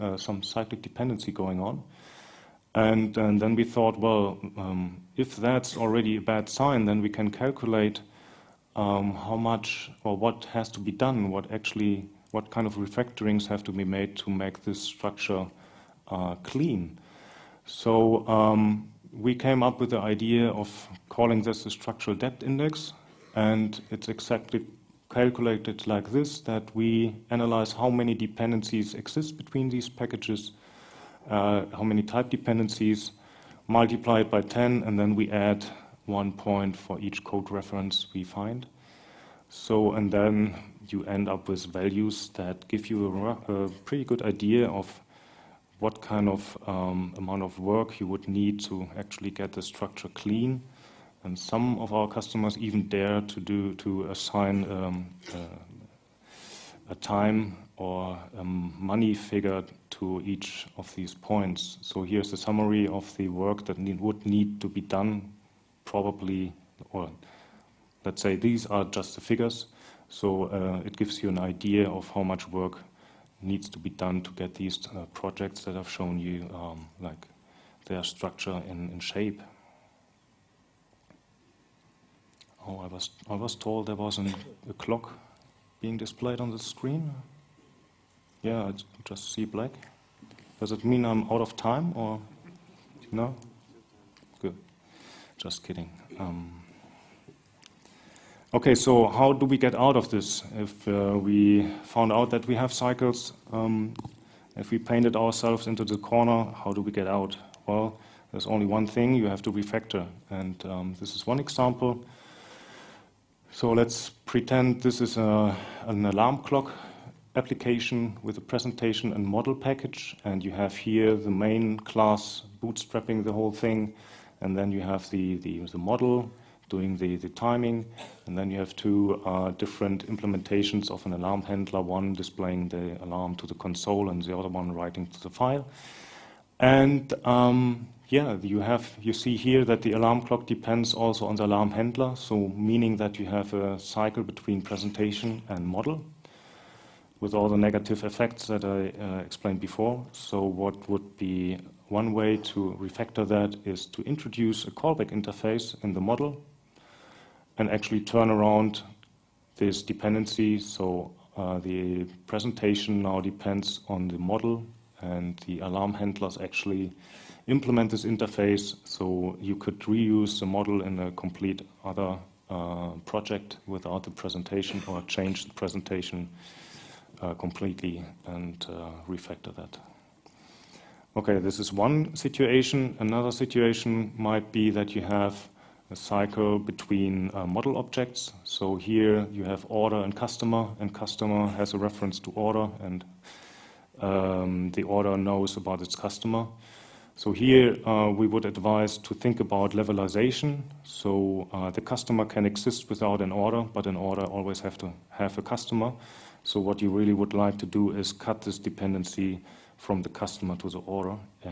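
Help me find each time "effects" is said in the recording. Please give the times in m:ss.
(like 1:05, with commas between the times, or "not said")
2:28.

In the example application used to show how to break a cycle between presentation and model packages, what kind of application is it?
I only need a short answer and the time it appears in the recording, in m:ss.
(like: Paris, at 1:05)
An alarm clock, at 1:56.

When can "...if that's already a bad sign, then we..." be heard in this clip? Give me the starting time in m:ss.
0:05.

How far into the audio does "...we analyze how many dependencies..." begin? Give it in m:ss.
0:26.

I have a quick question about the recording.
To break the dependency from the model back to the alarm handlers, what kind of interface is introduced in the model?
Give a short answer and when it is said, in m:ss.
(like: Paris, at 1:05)
A callback interface, at 2:34.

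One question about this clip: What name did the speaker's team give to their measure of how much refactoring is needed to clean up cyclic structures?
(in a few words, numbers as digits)
Structural debt index.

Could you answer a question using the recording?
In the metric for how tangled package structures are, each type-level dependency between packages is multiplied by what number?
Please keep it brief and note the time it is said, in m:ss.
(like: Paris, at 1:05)
10, at 0:33.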